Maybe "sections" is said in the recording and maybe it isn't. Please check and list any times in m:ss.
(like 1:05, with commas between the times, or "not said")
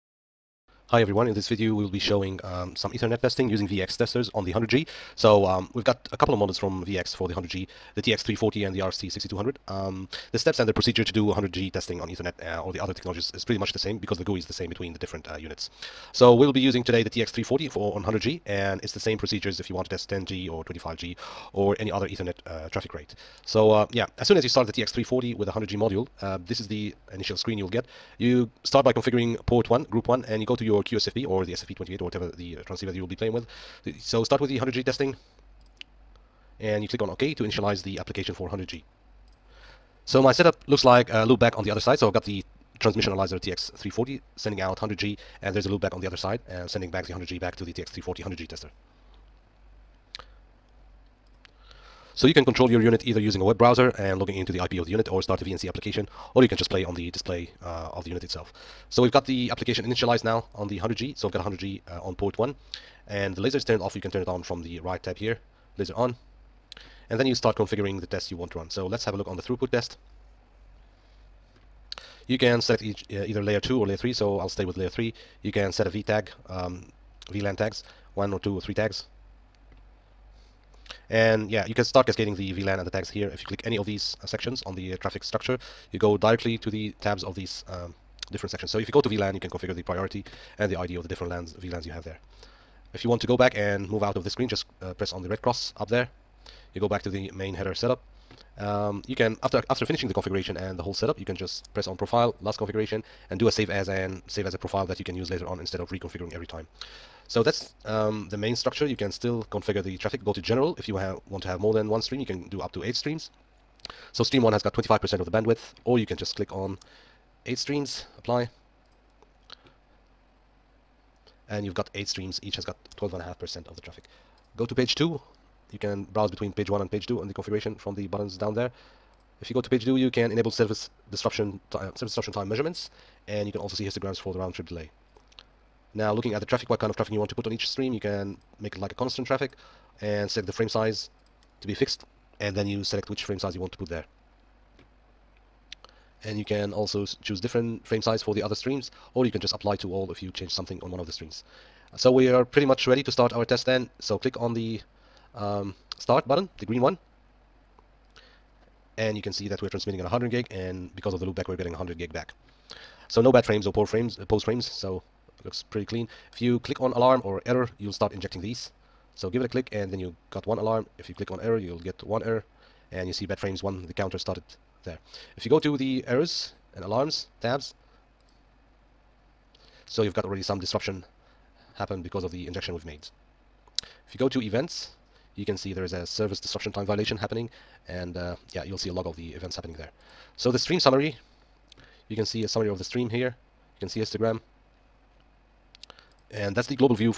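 1:24, 1:28.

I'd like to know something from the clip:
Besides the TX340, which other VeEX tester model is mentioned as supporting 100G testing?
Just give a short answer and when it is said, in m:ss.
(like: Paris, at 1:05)
RXT6200, at 0:08.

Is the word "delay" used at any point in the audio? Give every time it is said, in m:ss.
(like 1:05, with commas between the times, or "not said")
2:14.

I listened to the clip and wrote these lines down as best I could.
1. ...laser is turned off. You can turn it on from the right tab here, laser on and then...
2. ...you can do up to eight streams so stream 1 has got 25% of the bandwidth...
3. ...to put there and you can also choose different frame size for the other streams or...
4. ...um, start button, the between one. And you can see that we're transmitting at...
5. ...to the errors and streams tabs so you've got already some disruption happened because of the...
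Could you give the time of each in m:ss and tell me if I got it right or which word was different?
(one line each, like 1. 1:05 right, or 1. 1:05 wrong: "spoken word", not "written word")
1. 1:03 right
2. 1:52 right
3. 2:23 right
4. 2:35 wrong: "green", not "between"
5. 2:55 wrong: "alarms", not "streams".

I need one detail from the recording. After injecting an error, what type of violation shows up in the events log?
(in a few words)
Service disruption time violation.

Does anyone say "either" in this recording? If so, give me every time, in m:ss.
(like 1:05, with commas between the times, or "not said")
0:53, 1:13.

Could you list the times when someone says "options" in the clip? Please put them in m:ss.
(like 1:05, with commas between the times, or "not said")
not said.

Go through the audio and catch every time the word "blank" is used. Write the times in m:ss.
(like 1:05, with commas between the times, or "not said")
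not said.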